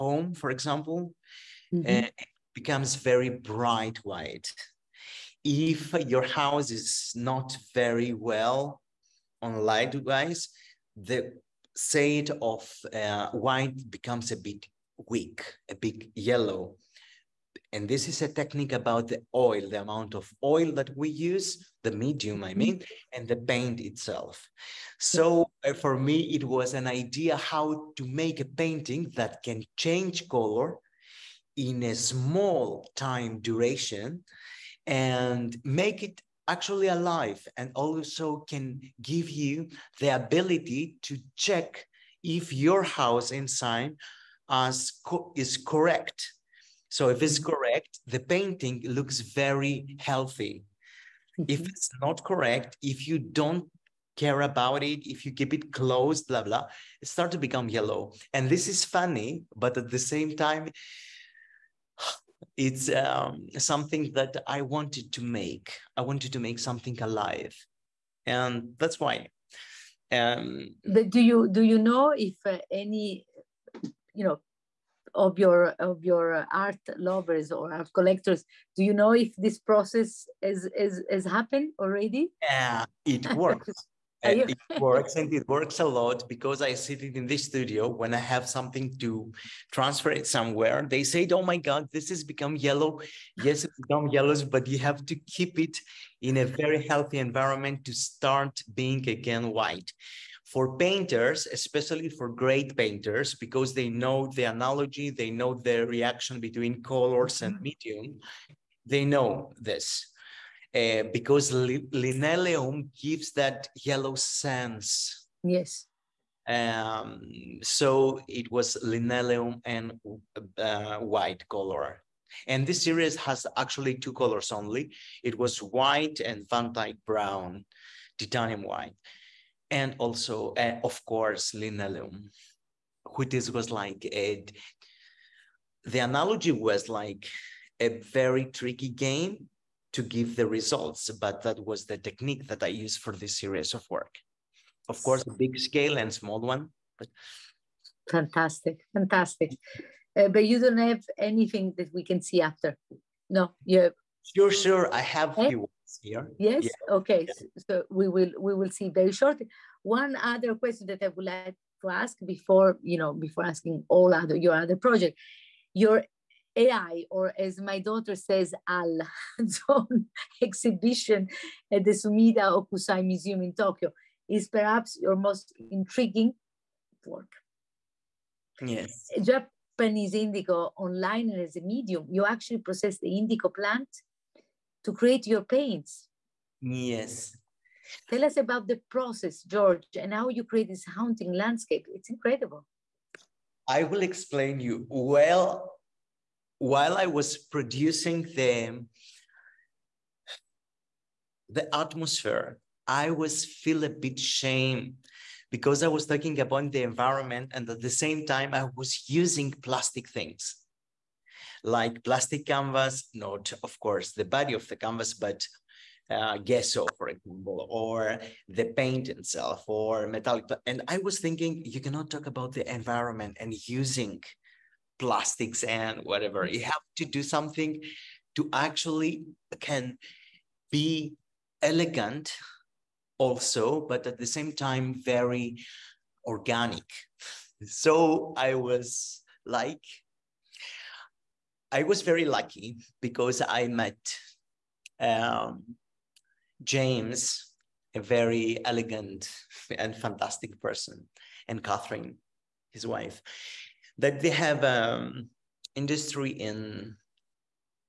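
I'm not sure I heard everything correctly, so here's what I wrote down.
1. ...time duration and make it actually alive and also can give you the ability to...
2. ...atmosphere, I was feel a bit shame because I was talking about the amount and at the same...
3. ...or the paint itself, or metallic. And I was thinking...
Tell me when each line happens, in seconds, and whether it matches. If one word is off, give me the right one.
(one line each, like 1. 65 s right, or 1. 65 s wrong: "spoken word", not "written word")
1. 32 s right
2. 201 s wrong: "environment", not "amount"
3. 217 s right.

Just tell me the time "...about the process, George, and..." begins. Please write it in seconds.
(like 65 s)
188 s.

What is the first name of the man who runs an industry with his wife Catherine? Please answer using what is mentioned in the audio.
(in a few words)
James.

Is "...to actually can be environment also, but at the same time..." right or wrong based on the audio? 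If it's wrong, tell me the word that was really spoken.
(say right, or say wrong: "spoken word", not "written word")
wrong: "elegant", not "environment".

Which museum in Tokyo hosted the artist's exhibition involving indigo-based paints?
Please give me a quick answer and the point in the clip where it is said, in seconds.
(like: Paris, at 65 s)
Sumida Hokusai Museum, at 171 s.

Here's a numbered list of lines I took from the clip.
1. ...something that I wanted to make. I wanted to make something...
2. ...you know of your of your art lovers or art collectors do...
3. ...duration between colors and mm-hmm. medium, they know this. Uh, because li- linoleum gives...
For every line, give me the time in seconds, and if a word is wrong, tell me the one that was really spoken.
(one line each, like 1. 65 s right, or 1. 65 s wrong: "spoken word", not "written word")
1. 63 s right
2. 74 s right
3. 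105 s wrong: "reaction", not "duration".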